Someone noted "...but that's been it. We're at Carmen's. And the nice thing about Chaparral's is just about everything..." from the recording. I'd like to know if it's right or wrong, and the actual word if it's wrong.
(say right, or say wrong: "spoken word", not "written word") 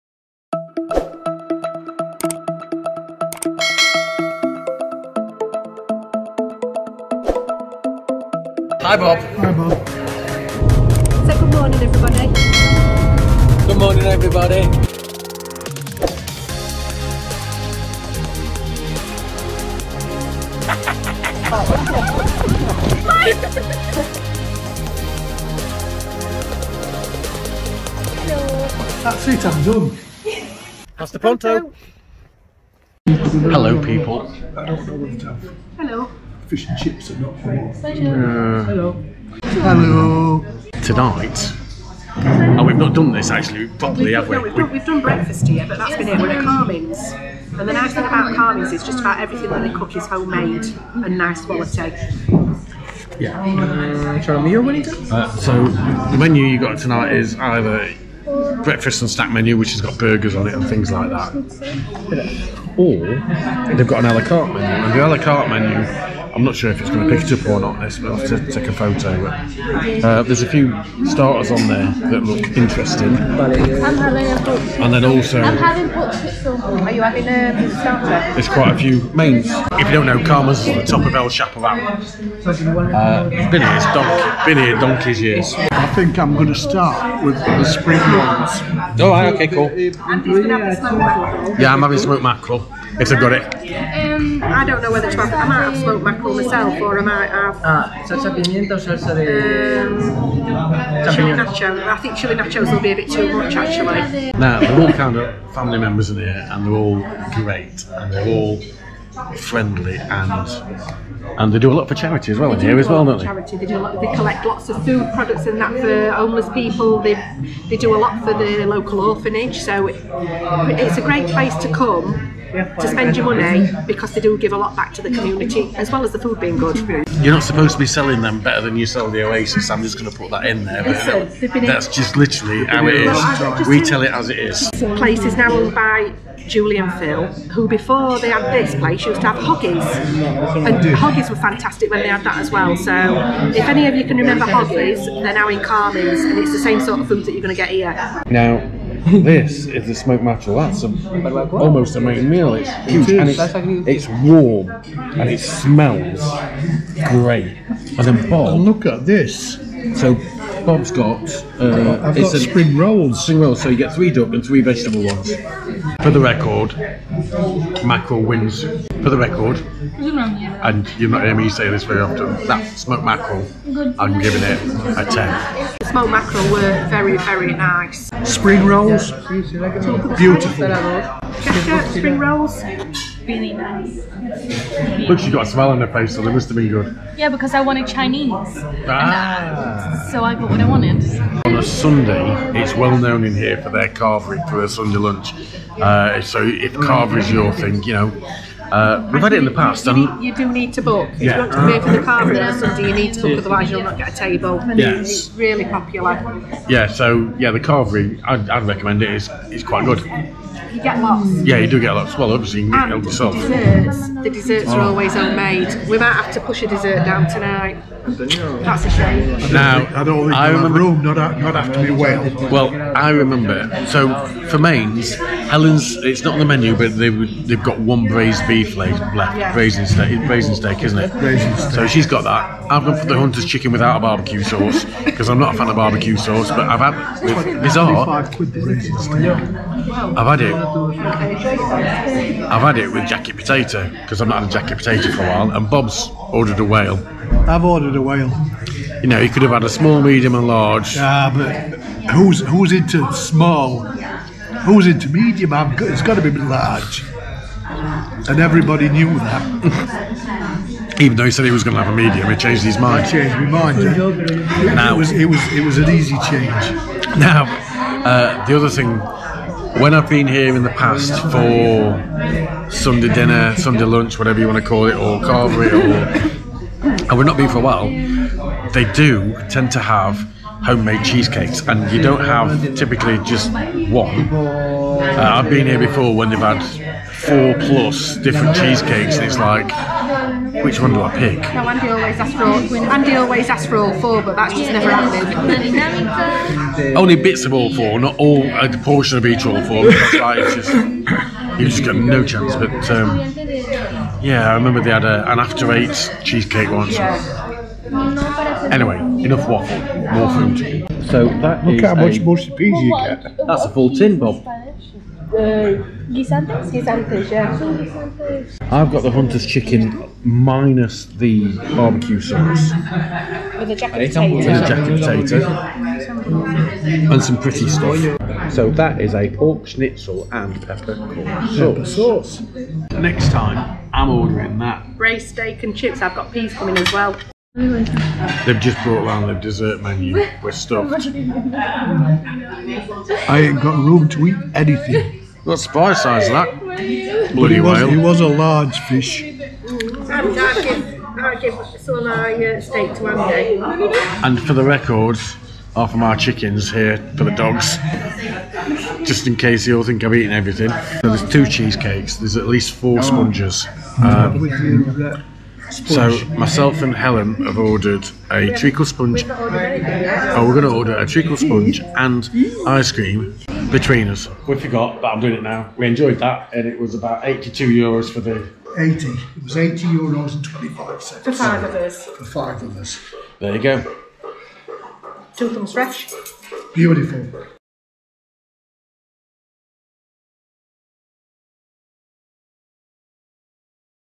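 wrong: "Carmen", not "Chaparral".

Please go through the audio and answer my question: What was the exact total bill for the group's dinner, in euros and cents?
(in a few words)
80 euros 25 cents.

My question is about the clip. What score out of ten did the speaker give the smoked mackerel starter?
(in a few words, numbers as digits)
10.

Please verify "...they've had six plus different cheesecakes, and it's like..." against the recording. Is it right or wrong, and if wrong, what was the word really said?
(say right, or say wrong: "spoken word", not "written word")
wrong: "four", not "six".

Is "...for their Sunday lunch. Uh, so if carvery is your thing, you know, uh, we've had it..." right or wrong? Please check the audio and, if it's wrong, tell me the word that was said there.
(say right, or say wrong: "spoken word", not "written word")
right.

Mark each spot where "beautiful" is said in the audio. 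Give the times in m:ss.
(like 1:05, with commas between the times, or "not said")
2:59, 6:26.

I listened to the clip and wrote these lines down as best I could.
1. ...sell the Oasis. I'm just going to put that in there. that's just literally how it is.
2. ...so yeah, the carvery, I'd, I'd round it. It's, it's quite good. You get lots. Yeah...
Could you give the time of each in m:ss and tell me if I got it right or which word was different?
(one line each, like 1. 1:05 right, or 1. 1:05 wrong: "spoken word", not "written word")
1. 2:08 right
2. 3:26 wrong: "recommend", not "round".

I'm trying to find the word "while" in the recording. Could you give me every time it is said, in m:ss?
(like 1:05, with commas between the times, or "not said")
4:05, 4:37.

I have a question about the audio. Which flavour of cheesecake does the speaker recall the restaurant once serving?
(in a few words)
After Eight.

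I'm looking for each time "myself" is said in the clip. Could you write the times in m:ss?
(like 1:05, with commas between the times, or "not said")
1:36, 6:06.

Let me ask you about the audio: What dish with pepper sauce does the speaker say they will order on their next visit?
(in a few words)
Pork schnitzel.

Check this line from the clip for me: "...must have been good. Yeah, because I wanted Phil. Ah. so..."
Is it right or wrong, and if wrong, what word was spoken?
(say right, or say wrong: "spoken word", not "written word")
wrong: "Chinese", not "Phil".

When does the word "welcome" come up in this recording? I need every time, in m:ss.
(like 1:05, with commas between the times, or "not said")
not said.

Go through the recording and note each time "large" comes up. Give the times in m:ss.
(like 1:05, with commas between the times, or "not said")
4:10, 4:16, 5:48.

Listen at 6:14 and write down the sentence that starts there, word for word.
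We forgot, but I'm doing it now.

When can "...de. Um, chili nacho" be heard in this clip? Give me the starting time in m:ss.
1:39.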